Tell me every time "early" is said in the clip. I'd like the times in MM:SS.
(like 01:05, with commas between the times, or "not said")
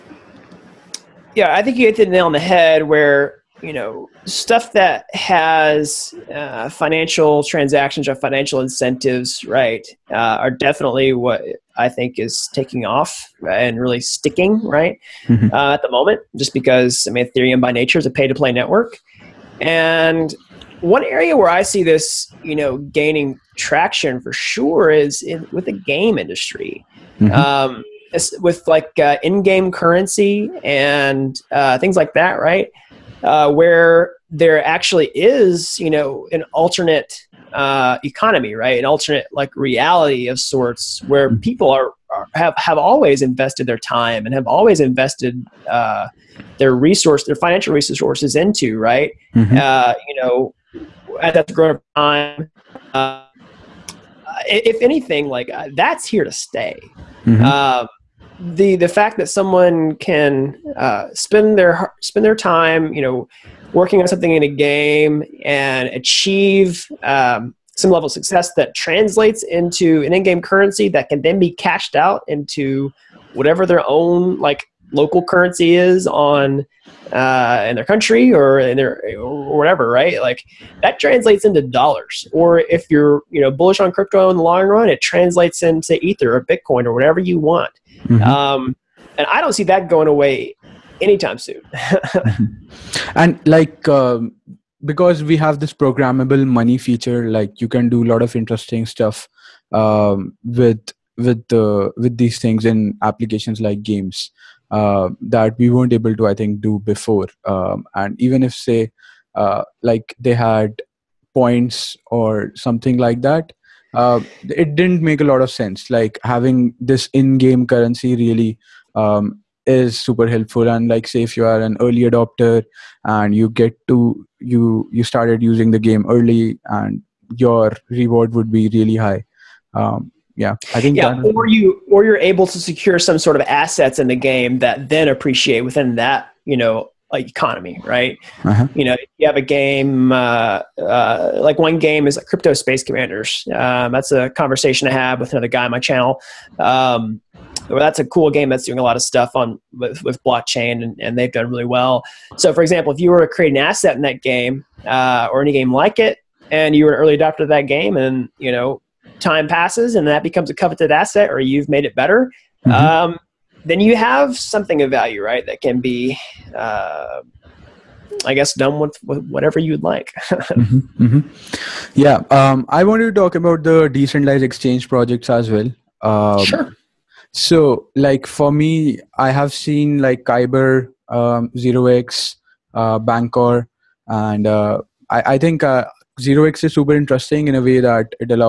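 02:01, 02:06, 02:36.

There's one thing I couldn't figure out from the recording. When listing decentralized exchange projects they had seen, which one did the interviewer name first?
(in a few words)
Kyber.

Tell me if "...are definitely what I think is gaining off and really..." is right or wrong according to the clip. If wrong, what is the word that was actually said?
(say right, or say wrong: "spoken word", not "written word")
wrong: "taking", not "gaining".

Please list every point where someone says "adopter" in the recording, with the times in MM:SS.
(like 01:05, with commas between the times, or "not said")
02:02, 02:37.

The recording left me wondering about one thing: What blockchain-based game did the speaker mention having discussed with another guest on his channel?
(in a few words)
Crypto Space Commanders.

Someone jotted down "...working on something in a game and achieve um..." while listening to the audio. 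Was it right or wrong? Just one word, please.
right.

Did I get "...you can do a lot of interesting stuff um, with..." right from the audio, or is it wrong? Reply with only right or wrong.
right.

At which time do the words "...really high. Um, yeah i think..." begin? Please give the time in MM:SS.
02:08.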